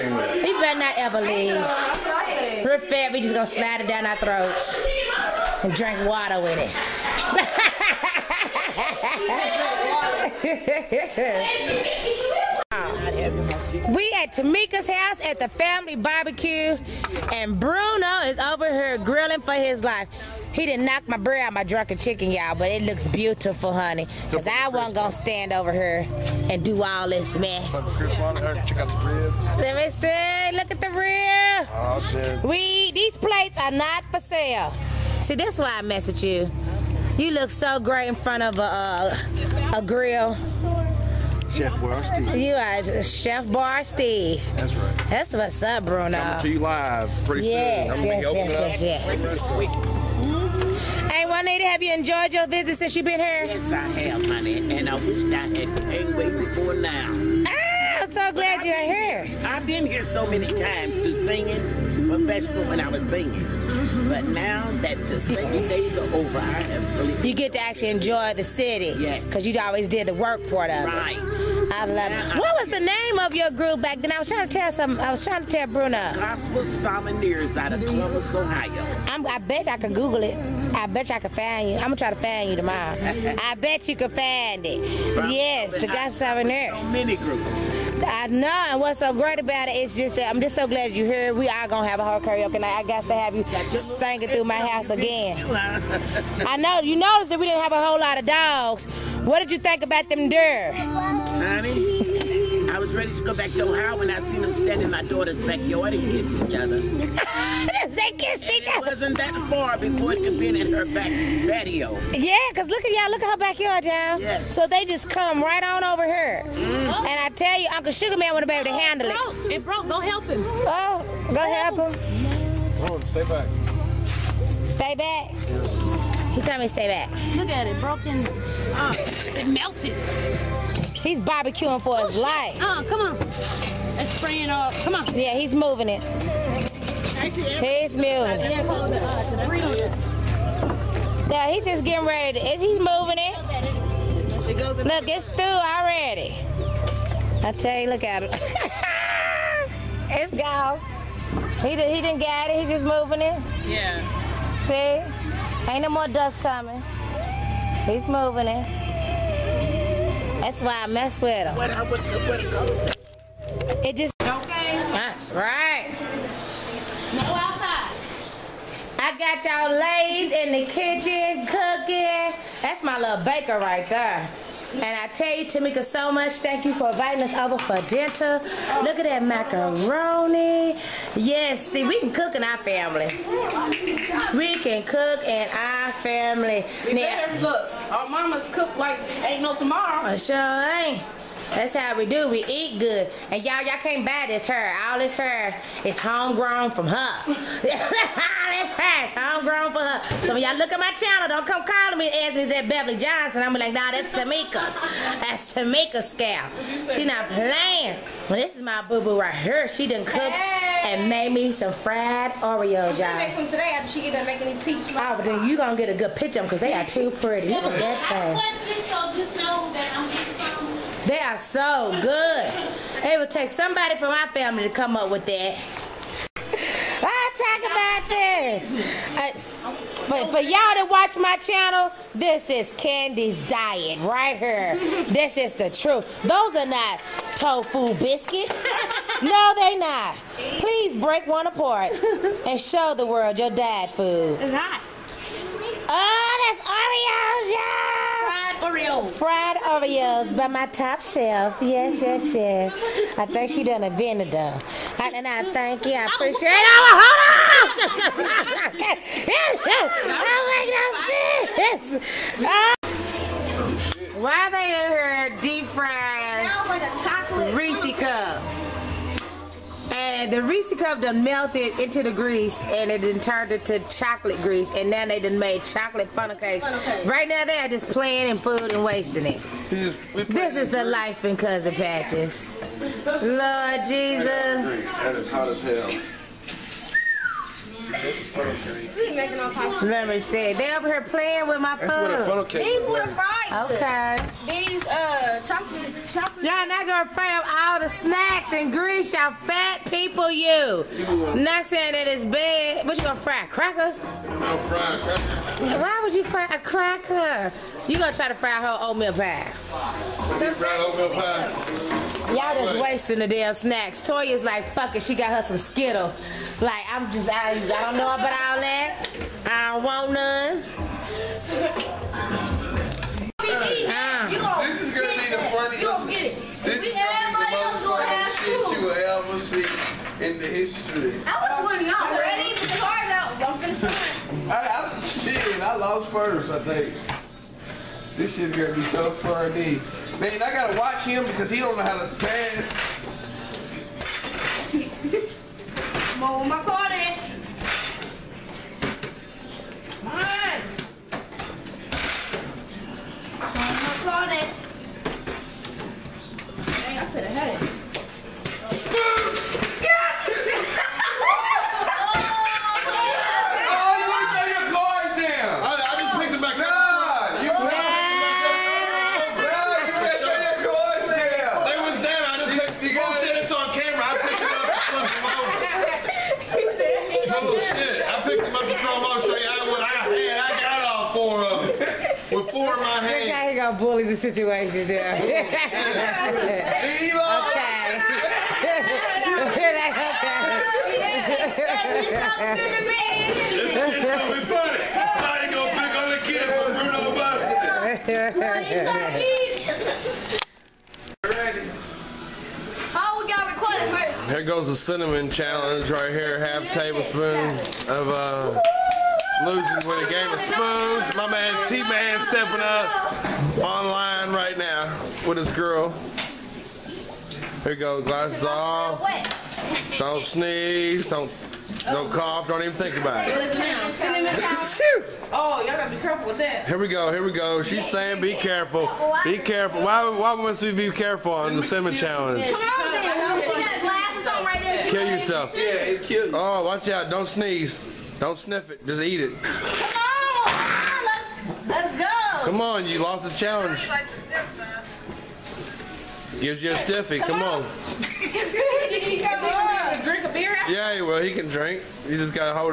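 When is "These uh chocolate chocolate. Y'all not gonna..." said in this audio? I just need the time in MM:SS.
04:54.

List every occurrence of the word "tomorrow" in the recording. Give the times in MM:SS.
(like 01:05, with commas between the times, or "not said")
01:22, 03:09.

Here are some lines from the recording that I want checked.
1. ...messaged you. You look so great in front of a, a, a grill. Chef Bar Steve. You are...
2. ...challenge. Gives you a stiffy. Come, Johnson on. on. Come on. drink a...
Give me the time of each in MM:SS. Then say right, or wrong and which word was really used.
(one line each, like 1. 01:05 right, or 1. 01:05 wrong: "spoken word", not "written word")
1. 00:35 right
2. 07:23 wrong: "Come", not "Johnson".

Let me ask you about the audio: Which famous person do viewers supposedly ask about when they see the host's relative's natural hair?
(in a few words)
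Beverly Johnson.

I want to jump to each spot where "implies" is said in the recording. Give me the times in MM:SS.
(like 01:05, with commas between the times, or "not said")
not said.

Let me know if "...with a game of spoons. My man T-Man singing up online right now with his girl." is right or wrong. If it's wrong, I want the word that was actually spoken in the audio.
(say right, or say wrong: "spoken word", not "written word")
wrong: "stepping", not "singing".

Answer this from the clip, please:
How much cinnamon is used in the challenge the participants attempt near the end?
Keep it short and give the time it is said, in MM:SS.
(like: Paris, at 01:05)
half tablespoon, at 06:46.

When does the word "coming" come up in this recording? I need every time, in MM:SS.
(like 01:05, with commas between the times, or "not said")
00:46, 02:36.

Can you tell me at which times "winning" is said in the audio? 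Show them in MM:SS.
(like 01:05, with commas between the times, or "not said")
05:31.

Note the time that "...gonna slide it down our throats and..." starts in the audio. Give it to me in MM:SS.
00:03.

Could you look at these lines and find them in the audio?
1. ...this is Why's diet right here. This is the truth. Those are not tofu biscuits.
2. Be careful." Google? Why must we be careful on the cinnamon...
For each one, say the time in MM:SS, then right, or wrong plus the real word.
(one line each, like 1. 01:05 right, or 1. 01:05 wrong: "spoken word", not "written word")
1. 03:52 wrong: "Candy", not "Why"
2. 07:09 wrong: "Why", not "Google".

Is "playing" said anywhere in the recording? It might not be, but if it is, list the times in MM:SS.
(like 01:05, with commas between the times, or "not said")
03:27, 04:37, 04:51.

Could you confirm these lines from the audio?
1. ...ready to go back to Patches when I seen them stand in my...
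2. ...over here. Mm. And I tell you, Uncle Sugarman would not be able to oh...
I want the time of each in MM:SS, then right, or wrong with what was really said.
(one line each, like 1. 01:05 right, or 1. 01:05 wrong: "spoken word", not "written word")
1. 01:42 wrong: "Ohio", not "Patches"
2. 01:55 right.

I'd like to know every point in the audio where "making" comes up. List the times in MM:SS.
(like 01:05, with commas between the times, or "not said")
03:34, 04:47.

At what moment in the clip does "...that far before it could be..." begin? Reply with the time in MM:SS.
01:49.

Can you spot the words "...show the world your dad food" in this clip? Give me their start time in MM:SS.
04:02.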